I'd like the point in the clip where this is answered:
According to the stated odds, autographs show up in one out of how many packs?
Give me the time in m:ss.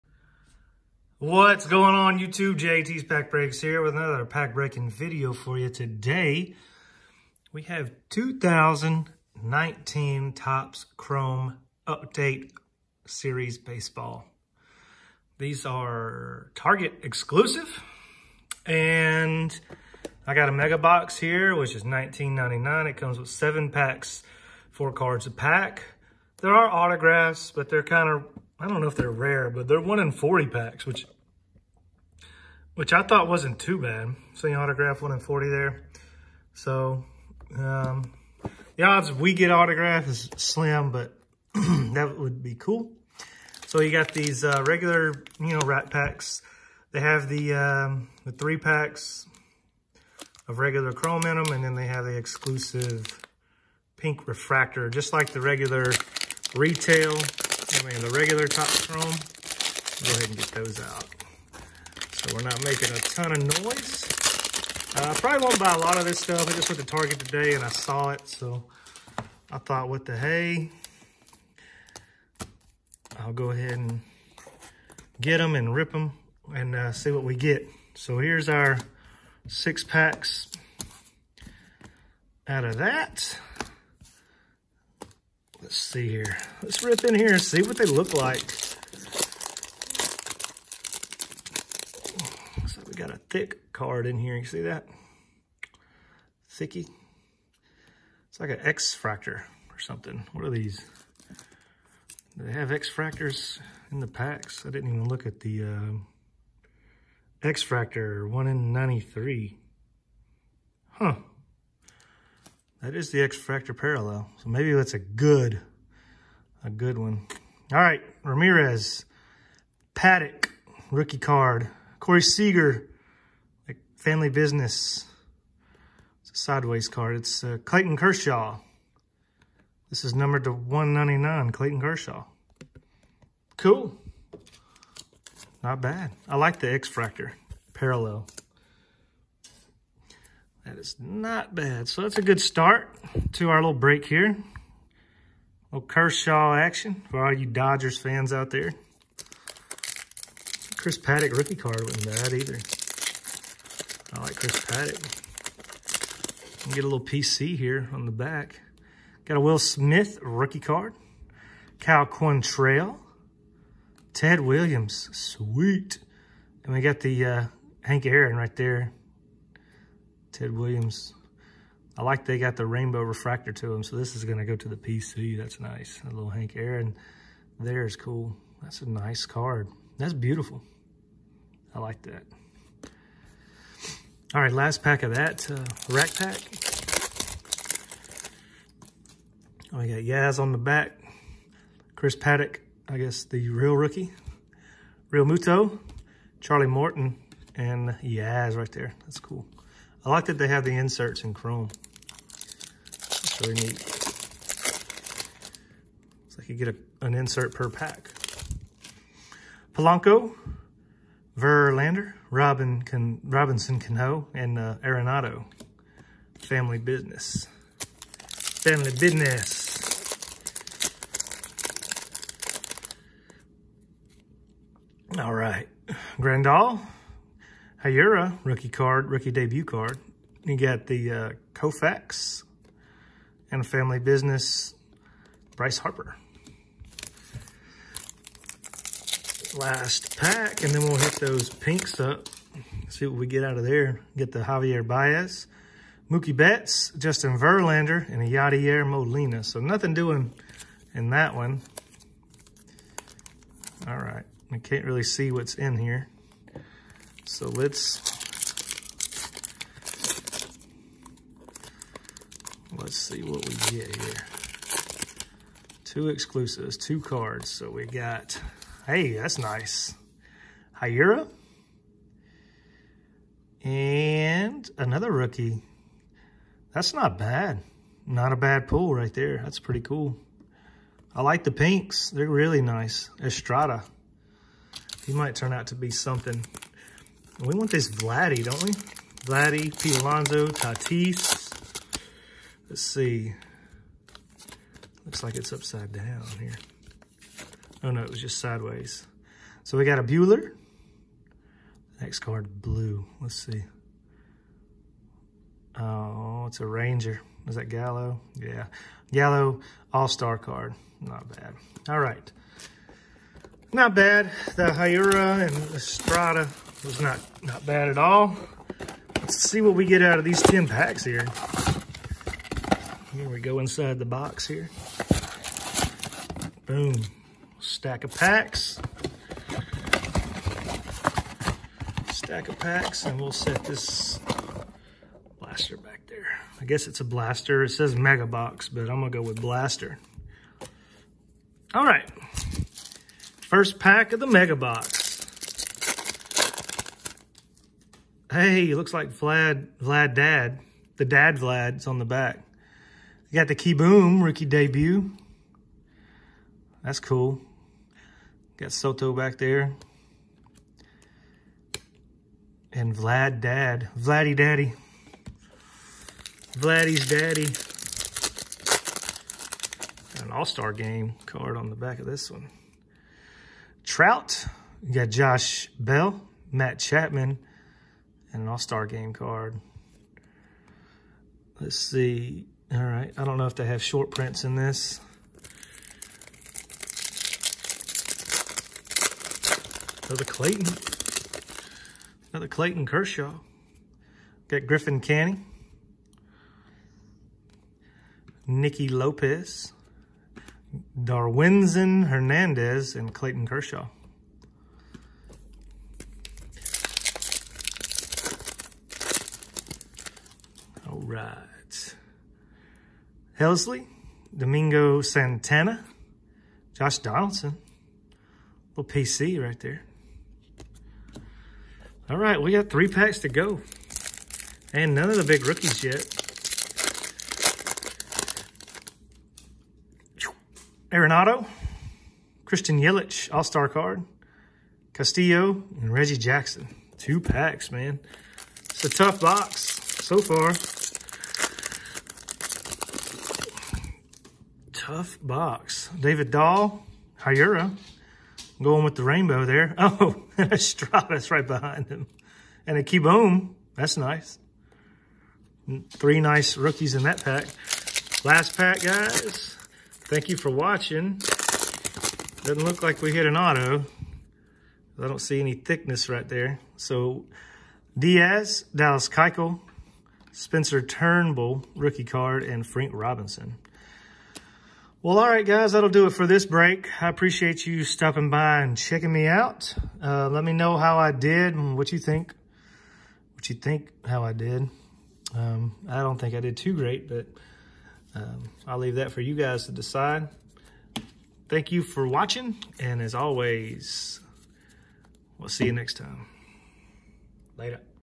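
0:29.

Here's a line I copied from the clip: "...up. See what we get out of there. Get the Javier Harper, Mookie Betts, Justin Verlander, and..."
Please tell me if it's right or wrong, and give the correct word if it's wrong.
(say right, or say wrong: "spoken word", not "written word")
wrong: "Baez", not "Harper".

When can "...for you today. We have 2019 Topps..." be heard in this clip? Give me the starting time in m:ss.
0:05.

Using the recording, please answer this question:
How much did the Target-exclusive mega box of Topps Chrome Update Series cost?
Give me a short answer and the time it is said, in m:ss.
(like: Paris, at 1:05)
$19.99, at 0:21.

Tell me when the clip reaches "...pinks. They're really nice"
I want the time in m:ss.
4:41.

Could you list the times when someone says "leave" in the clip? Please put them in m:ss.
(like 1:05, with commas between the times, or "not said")
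8:08.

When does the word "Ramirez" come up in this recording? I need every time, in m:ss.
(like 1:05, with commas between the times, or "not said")
1:58.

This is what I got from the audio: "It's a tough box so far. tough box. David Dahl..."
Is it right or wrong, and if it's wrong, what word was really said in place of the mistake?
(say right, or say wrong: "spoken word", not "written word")
right.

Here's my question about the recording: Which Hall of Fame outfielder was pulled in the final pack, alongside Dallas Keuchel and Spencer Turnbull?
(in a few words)
Frank Robinson.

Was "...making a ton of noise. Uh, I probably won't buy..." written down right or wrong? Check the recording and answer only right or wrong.
right.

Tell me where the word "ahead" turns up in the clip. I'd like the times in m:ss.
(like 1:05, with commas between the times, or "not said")
1:00, 1:13.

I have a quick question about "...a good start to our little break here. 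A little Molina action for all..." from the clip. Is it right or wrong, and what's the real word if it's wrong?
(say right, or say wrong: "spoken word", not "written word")
wrong: "Kershaw", not "Molina".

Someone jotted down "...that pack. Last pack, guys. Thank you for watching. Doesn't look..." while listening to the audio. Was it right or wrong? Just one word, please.
right.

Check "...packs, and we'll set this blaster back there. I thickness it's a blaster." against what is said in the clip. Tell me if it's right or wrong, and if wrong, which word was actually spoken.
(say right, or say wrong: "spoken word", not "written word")
wrong: "guess", not "thickness".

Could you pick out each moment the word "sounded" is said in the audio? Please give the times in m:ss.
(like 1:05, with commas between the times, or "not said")
not said.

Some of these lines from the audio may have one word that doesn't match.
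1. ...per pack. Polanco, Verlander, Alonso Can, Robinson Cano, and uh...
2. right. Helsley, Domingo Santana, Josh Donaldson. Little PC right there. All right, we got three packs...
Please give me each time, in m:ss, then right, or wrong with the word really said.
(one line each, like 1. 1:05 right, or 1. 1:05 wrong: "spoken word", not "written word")
1. 3:27 wrong: "Robin", not "Alonso"
2. 6:51 right.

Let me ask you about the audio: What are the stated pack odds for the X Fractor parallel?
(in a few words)
1 in 93.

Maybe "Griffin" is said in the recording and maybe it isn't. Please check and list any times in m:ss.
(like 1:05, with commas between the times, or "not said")
6:34.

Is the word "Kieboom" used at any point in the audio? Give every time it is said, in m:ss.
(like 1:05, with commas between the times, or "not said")
5:53, 7:32.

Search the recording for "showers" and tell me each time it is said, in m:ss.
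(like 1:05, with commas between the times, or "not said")
not said.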